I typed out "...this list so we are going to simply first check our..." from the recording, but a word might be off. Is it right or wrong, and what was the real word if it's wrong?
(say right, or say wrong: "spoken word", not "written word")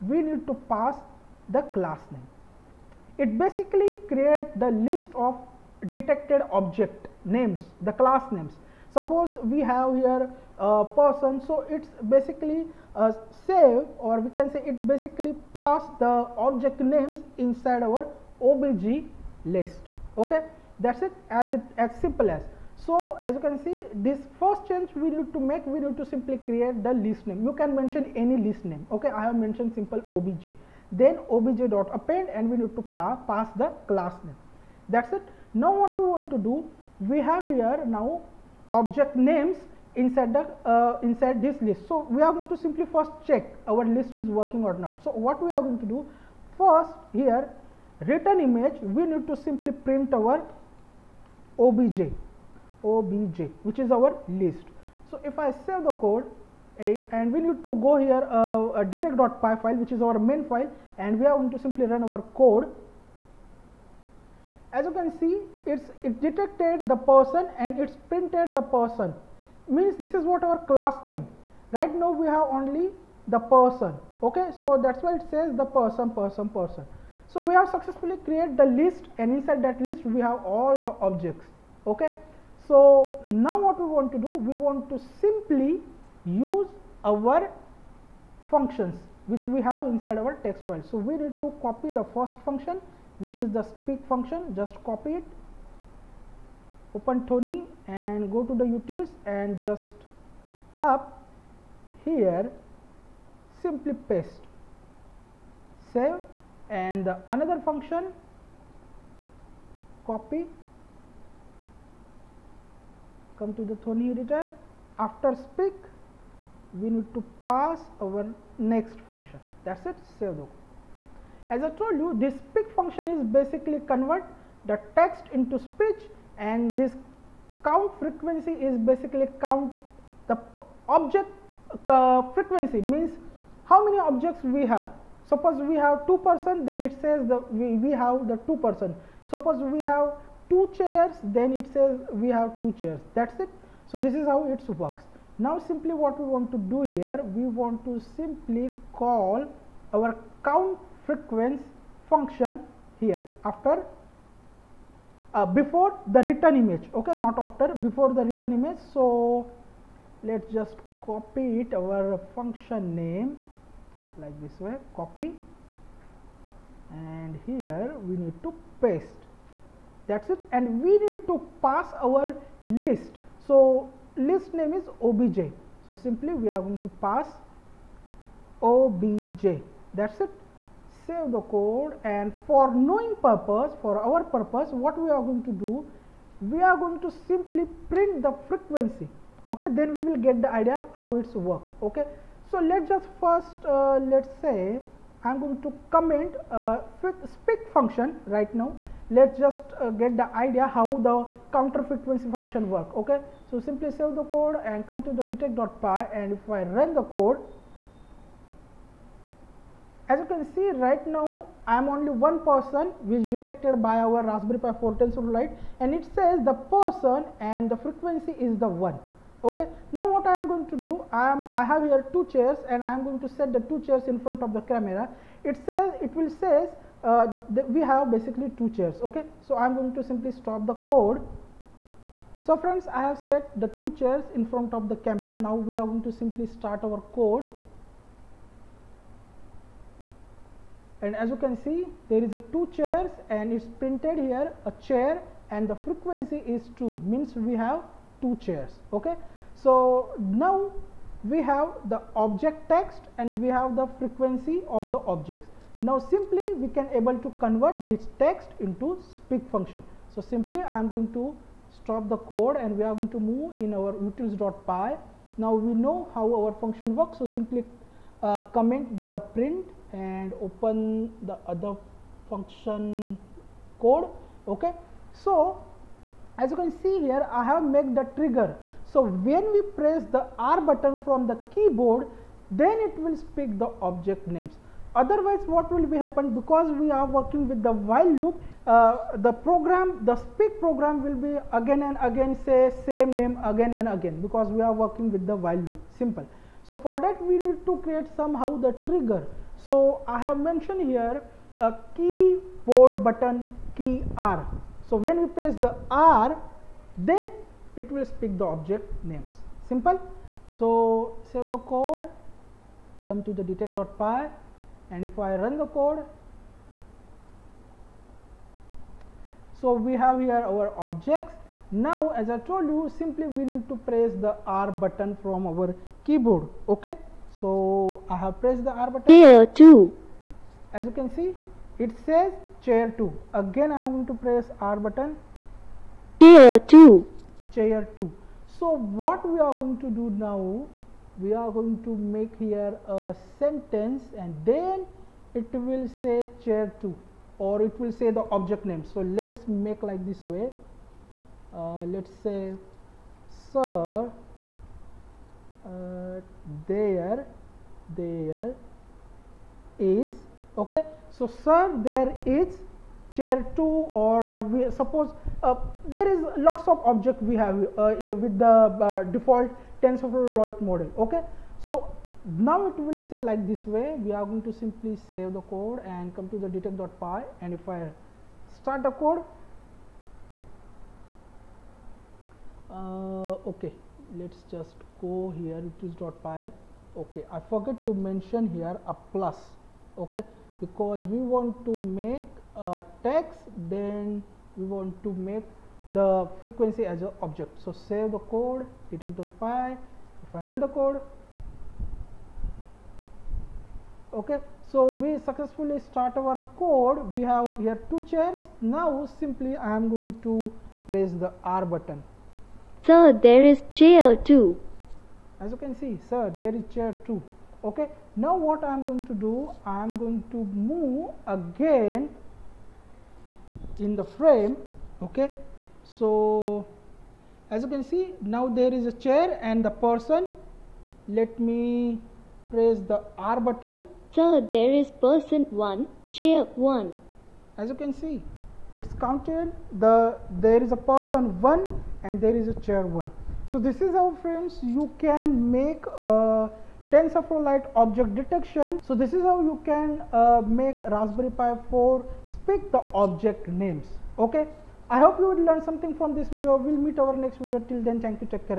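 right.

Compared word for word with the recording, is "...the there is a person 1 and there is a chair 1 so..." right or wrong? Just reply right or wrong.
right.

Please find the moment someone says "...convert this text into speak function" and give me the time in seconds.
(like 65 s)
257 s.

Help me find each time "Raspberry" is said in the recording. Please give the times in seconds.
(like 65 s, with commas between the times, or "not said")
214 s, 450 s.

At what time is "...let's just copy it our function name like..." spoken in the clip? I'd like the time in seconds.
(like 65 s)
160 s.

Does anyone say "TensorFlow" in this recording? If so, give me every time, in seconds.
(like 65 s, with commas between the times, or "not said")
369 s, 446 s.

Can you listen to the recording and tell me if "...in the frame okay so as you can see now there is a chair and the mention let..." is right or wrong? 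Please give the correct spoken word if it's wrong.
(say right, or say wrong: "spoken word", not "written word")
wrong: "person", not "mention".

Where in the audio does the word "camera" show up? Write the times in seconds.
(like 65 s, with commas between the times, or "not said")
224 s, 235 s.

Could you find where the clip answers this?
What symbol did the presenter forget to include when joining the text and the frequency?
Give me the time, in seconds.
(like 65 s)
388 s.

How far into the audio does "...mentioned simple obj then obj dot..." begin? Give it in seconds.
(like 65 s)
29 s.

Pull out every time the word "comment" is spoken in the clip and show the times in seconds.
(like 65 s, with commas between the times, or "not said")
195 s, 268 s.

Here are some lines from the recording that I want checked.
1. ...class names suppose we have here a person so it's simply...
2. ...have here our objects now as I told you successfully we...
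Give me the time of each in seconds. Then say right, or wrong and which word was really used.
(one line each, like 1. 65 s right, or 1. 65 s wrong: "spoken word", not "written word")
1. 7 s wrong: "basically", not "simply"
2. 319 s wrong: "simply", not "successfully".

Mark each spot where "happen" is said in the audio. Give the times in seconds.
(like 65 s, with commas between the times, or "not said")
285 s.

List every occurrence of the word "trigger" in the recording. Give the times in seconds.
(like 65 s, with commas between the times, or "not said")
278 s, 298 s.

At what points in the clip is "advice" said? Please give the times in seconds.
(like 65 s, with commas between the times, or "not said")
not said.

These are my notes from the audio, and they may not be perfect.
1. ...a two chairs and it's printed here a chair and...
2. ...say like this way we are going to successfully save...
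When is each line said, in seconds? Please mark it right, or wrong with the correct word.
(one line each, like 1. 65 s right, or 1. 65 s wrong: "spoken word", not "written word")
1. 242 s right
2. 373 s wrong: "simply", not "successfully".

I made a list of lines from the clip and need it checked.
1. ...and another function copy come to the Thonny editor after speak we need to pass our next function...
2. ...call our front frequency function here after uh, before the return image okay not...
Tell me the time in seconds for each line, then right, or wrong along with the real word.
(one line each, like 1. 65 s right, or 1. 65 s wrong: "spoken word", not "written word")
1. 106 s right
2. 148 s wrong: "count", not "front".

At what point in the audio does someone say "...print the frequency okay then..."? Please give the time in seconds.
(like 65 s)
187 s.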